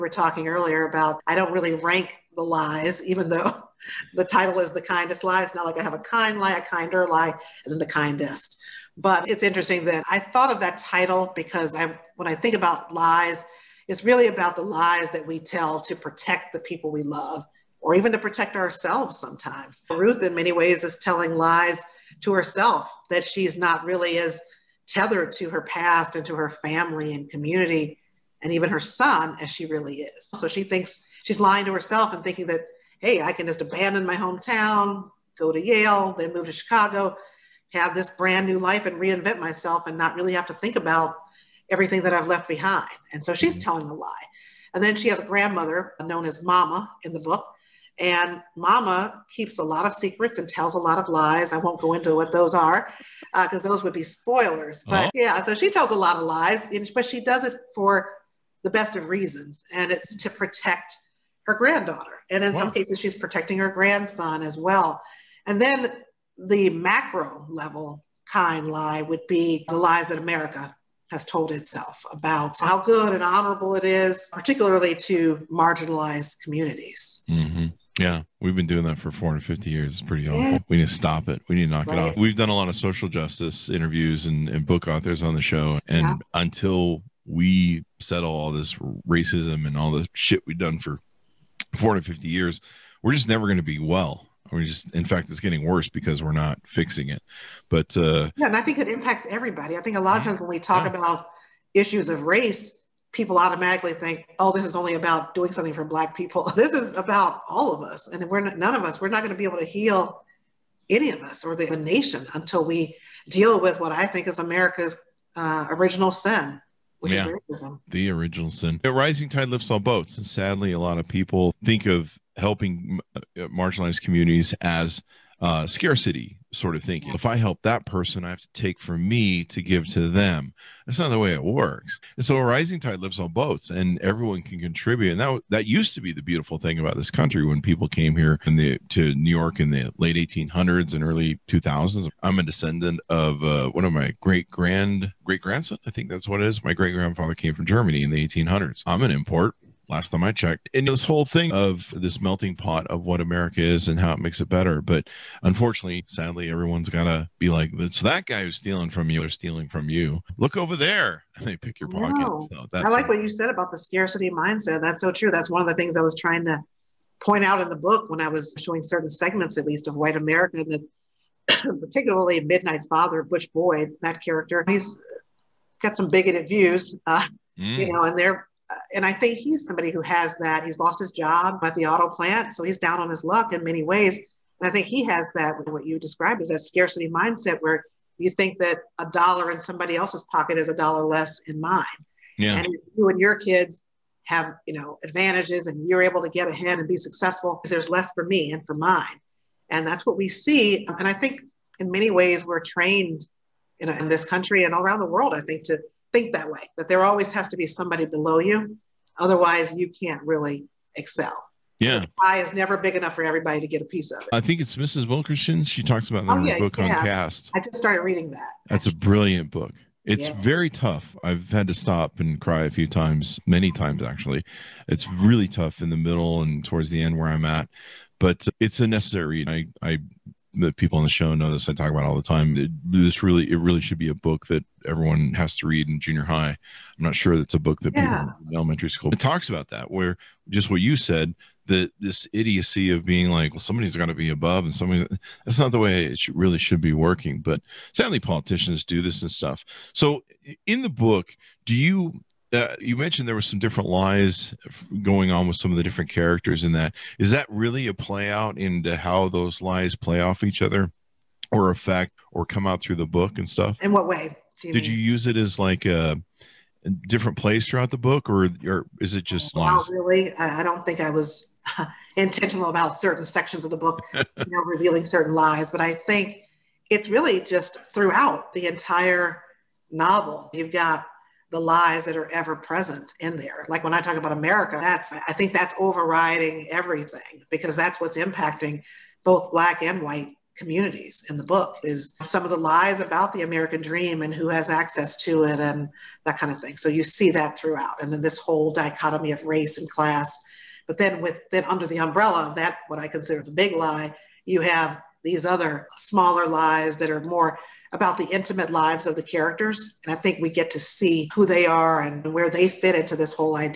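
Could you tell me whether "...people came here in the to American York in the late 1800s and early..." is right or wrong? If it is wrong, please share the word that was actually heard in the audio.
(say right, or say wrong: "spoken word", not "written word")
wrong: "New", not "American".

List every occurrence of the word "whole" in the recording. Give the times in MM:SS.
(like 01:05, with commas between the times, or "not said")
02:31, 04:58.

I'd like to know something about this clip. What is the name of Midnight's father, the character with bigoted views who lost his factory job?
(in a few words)
Butch Boyd.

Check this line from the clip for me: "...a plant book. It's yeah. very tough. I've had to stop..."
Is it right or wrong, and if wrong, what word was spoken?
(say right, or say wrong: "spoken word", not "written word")
wrong: "brilliant", not "plant".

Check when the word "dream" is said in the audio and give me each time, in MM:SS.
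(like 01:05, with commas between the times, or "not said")
04:53.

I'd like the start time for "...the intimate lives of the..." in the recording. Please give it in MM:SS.
05:08.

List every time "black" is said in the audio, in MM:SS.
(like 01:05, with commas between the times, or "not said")
01:45, 04:49.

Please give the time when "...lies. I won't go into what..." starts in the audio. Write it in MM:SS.
00:51.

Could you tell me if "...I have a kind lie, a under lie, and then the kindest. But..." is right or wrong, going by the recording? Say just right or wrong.
wrong.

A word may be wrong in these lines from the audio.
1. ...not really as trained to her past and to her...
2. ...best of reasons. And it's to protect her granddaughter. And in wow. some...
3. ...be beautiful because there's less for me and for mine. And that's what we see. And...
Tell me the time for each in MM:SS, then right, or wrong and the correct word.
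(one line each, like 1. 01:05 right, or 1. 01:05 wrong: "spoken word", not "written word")
1. 00:23 wrong: "tethered", not "trained"
2. 00:58 right
3. 03:16 wrong: "successful", not "beautiful".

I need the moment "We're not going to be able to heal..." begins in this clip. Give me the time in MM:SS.
01:49.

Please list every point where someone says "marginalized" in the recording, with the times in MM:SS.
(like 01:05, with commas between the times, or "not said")
01:15, 02:03.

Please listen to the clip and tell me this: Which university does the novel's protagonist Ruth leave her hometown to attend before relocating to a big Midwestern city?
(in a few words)
Yale.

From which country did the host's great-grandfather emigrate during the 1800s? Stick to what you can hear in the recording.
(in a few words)
Germany.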